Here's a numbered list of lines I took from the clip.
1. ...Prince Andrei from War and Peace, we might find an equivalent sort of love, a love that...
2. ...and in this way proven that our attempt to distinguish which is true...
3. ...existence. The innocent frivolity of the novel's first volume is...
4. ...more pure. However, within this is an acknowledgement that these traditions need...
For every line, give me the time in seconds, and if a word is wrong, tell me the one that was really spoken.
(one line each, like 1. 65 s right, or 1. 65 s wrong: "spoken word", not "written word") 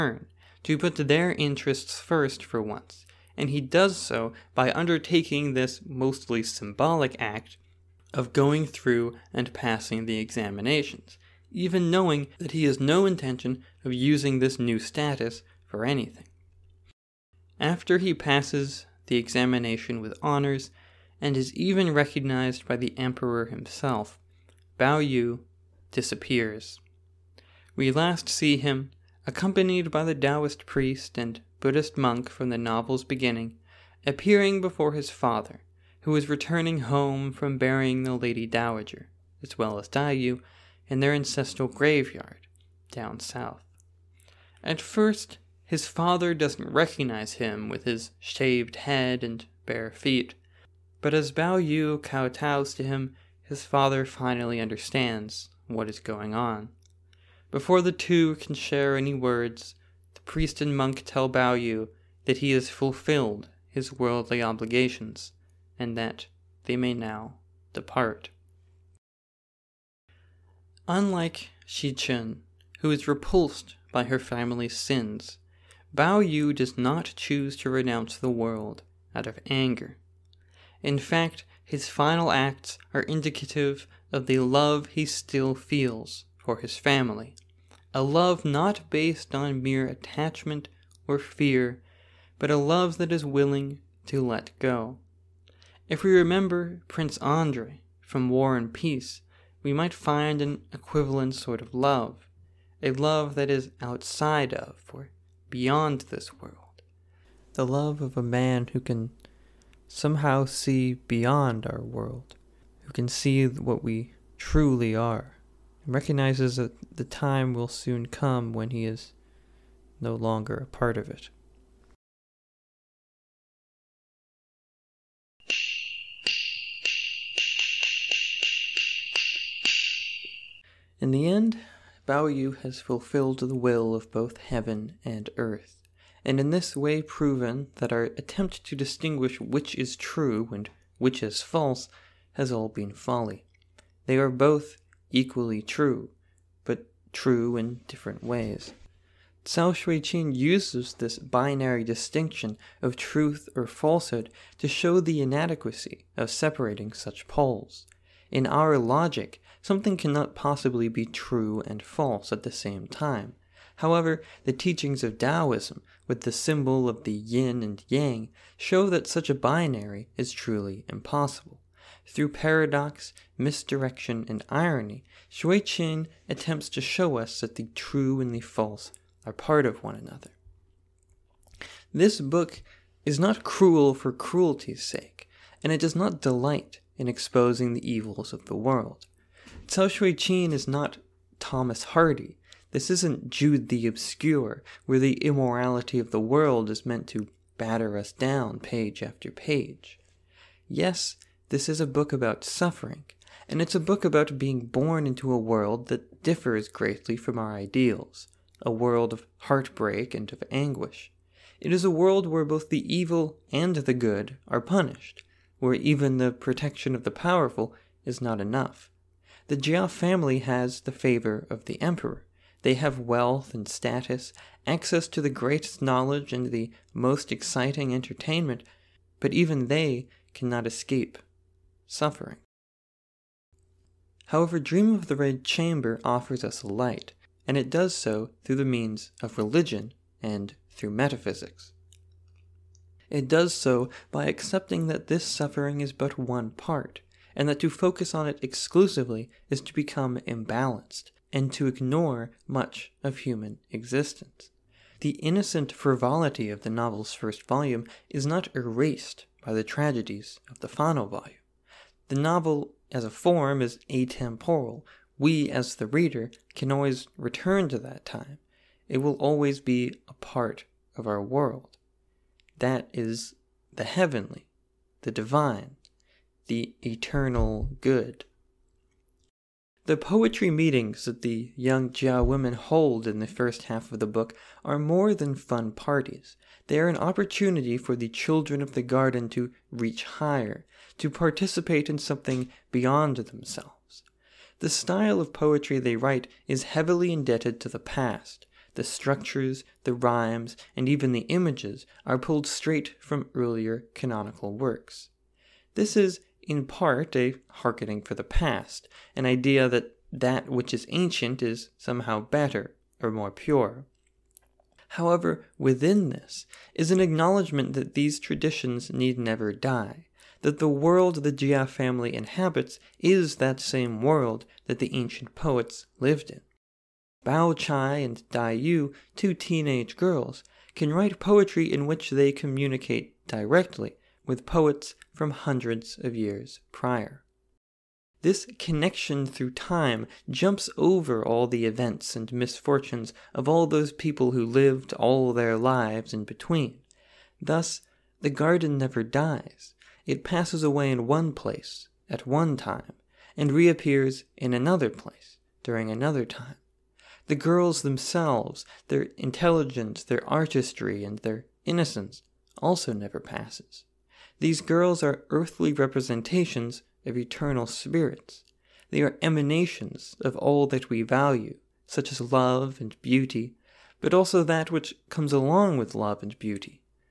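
1. 96 s right
2. 136 s right
3. 253 s right
4. 313 s right.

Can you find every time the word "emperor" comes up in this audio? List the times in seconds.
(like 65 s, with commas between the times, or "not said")
22 s, 221 s.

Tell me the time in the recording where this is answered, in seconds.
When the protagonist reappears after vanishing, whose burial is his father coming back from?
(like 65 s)
38 s.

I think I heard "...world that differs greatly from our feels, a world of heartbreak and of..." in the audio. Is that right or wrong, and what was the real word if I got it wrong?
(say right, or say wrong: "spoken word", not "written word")
wrong: "ideals", not "feels".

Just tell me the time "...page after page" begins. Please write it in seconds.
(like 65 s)
198 s.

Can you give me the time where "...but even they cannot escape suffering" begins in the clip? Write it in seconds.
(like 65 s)
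229 s.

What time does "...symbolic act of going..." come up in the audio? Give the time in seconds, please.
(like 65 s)
6 s.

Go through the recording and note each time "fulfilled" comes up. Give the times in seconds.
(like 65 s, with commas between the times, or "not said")
62 s, 132 s.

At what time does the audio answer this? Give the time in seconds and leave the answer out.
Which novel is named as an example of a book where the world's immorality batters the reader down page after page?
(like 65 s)
193 s.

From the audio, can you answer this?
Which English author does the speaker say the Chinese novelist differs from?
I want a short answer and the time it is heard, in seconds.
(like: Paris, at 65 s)
Thomas Hardy, at 191 s.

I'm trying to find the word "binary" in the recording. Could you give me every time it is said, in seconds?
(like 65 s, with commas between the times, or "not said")
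151 s, 169 s.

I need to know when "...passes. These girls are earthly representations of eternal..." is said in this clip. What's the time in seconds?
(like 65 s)
363 s.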